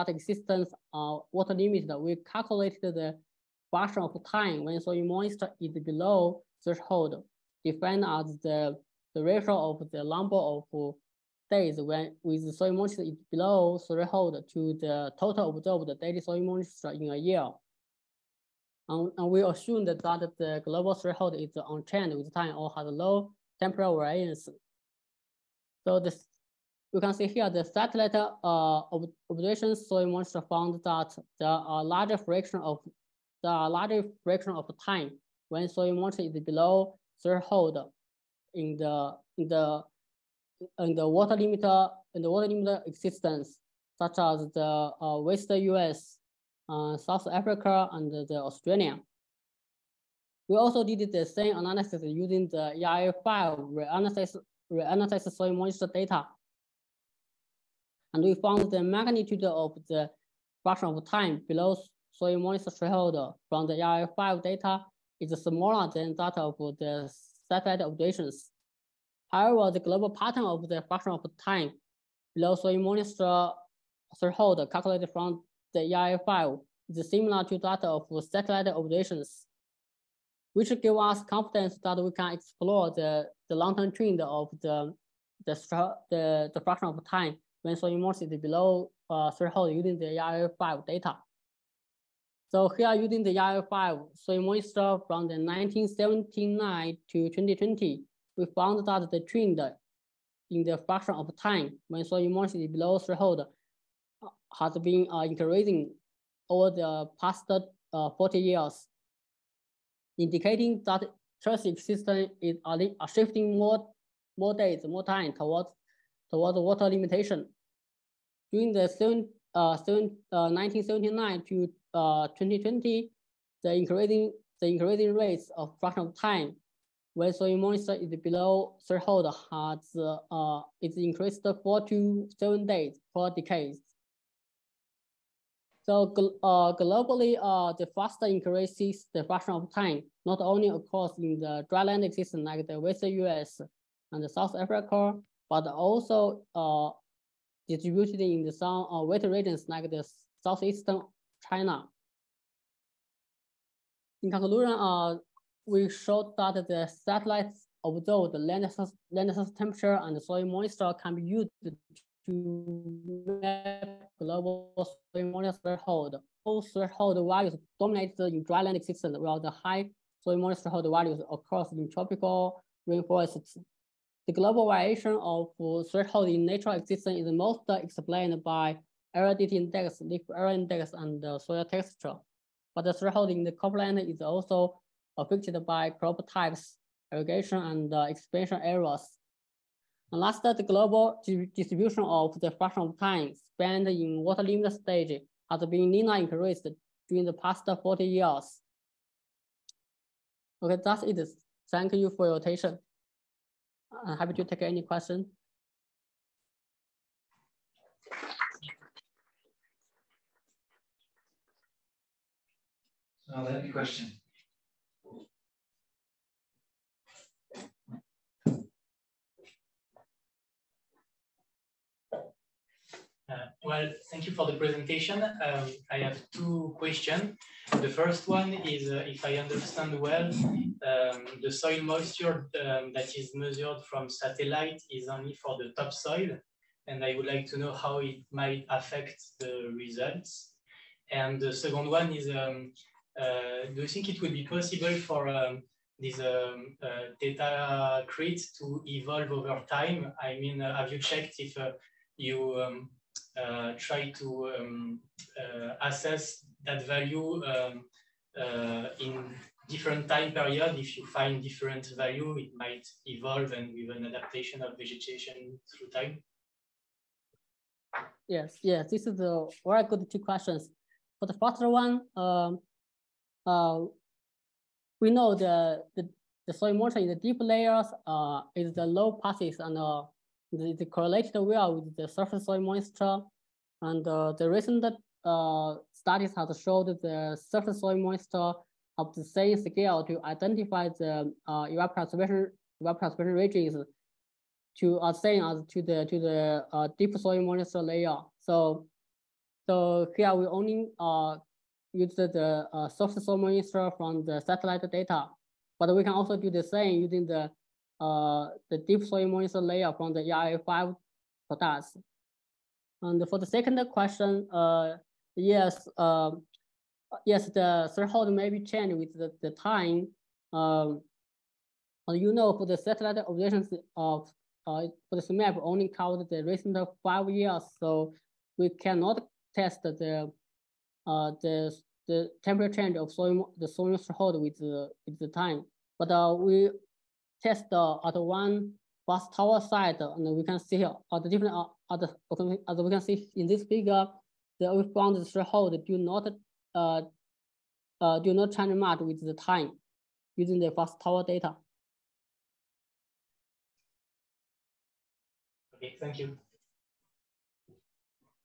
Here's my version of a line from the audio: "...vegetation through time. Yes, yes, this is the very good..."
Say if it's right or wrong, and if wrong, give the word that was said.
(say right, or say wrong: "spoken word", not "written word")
right.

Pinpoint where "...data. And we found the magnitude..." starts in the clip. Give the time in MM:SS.
00:55.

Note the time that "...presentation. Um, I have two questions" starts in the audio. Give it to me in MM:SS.
03:44.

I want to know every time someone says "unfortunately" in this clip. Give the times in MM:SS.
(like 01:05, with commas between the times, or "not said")
not said.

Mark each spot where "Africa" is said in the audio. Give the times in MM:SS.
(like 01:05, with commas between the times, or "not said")
00:47, 02:24.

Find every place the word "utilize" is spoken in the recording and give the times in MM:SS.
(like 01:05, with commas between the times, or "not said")
not said.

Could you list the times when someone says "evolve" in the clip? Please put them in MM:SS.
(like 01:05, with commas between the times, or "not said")
04:08, 04:23.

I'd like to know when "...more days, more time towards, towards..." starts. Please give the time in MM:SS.
01:54.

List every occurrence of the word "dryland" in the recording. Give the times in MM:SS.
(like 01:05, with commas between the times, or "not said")
02:21, 02:48.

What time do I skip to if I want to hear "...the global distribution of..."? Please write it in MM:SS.
03:10.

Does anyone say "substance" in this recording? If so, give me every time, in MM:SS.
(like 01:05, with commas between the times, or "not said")
not said.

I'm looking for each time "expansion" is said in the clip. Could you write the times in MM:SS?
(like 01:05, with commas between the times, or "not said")
03:08.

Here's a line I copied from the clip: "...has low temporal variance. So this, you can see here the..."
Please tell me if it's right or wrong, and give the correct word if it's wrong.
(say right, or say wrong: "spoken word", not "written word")
right.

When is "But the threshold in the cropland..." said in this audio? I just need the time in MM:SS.
03:02.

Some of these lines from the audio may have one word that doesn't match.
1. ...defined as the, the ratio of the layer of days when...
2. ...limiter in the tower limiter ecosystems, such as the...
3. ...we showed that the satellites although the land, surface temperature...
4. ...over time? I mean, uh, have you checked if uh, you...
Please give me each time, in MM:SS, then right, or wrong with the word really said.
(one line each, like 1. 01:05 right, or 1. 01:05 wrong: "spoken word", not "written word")
1. 00:07 wrong: "number", not "layer"
2. 00:41 wrong: "water", not "tower"
3. 02:35 right
4. 04:09 right.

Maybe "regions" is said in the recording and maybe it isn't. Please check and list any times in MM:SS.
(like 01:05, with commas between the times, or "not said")
02:29, 04:53.